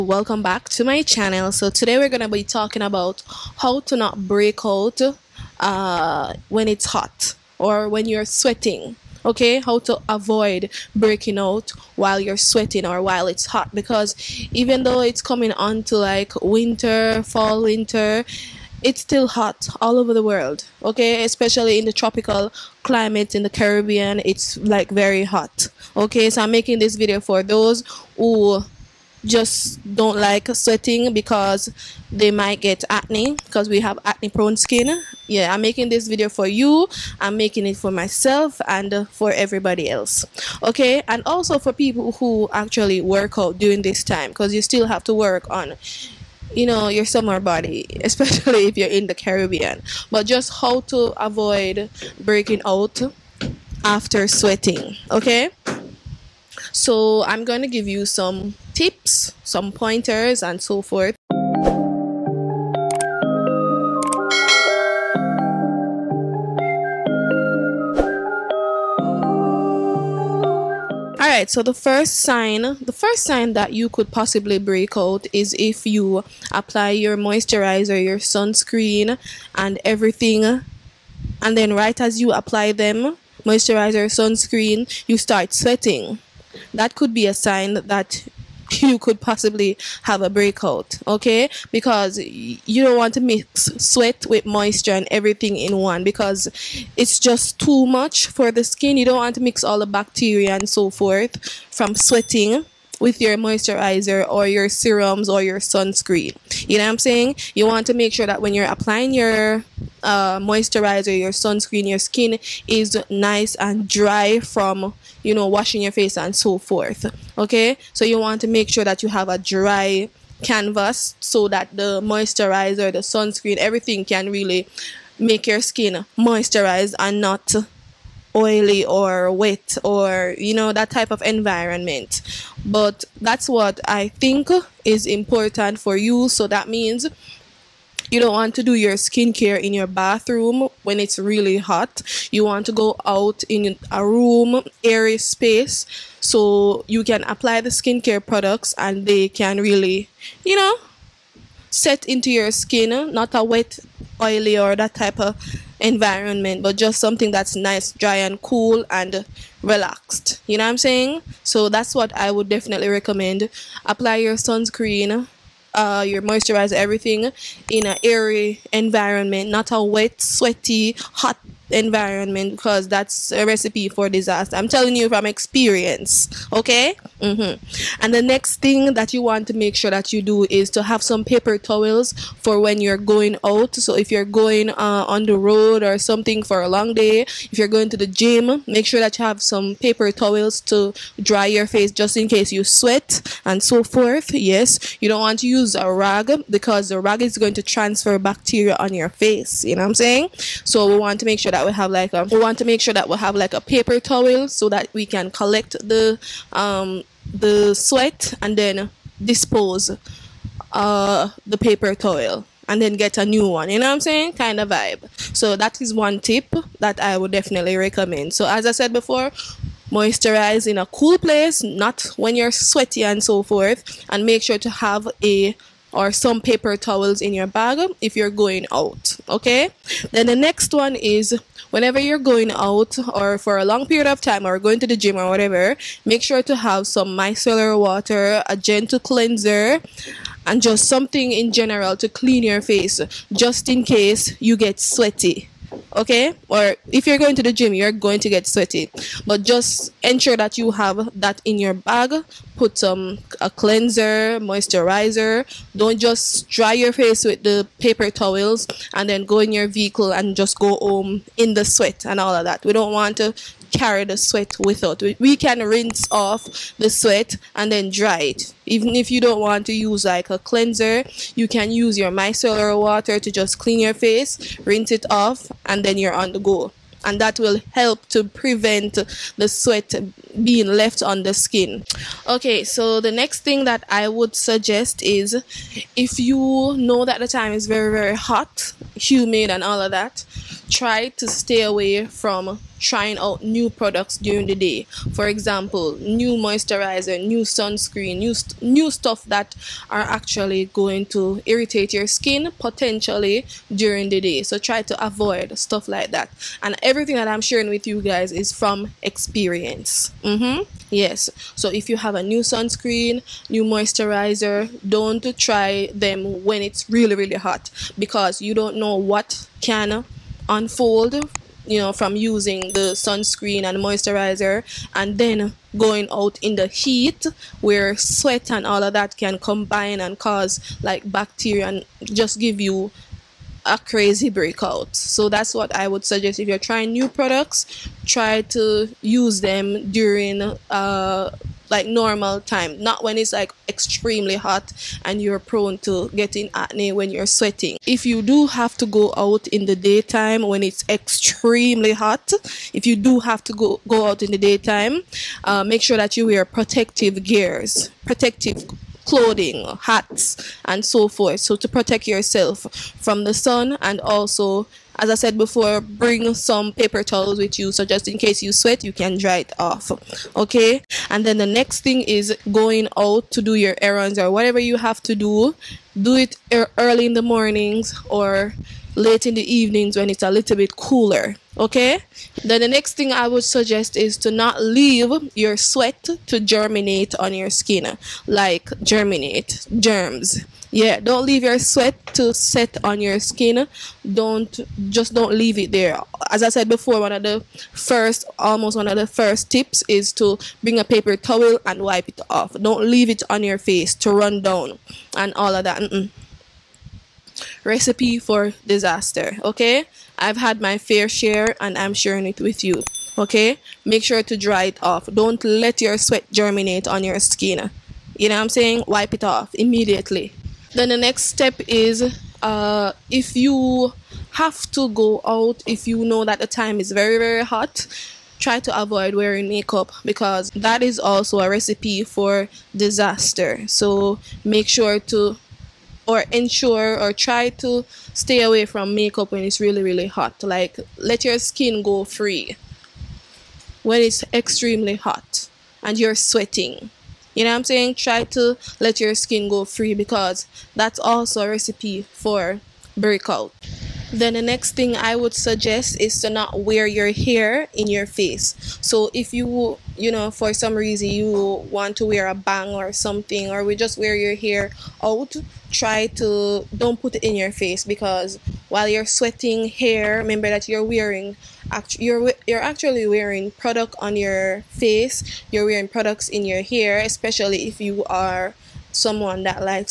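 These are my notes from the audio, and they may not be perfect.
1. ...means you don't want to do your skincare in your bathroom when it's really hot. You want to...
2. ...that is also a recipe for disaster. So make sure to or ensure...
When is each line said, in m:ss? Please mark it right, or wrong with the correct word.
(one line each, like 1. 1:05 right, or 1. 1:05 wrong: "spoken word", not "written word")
1. 2:16 right
2. 7:10 right.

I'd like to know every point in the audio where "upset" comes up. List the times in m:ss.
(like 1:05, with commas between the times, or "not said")
not said.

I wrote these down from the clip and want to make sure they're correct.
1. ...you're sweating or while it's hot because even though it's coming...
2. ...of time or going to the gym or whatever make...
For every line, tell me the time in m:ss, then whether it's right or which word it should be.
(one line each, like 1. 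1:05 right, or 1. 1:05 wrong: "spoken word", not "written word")
1. 0:12 right
2. 3:54 right.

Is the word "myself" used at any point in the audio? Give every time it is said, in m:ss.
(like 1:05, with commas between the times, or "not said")
0:37.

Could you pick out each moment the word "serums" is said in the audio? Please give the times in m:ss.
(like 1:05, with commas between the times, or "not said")
1:44.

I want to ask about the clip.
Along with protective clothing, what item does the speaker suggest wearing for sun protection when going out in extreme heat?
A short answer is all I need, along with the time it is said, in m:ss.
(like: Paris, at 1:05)
Hats, at 5:59.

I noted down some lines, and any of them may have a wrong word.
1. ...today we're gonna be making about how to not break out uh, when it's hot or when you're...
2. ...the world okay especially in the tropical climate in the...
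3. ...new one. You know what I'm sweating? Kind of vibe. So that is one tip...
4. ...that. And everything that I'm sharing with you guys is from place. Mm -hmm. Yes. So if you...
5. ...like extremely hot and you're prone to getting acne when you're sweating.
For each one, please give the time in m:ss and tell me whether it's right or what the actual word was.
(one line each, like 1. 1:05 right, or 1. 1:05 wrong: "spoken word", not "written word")
1. 0:01 wrong: "talking", not "making"
2. 0:20 right
3. 3:33 wrong: "saying", not "sweating"
4. 5:06 wrong: "experience", not "place"
5. 5:43 right.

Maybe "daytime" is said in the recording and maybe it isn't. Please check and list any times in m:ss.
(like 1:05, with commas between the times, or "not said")
5:49, 5:54.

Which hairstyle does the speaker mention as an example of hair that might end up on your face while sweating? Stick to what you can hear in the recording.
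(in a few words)
A bang.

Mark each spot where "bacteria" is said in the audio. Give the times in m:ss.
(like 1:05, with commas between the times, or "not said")
1:39, 3:18, 5:31.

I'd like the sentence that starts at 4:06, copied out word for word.
Or if you're going to the gym, you're going to get sweaty.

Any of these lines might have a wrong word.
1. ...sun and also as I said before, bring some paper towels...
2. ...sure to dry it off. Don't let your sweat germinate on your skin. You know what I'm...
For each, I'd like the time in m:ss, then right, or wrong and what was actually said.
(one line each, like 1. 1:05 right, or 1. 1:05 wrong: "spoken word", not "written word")
1. 6:03 right
2. 6:54 right.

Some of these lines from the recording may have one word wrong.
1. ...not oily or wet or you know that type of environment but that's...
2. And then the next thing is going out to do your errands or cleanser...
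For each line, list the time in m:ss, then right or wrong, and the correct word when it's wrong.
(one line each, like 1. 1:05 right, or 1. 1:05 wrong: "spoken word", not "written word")
1. 2:07 right
2. 6:11 wrong: "whatever", not "cleanser".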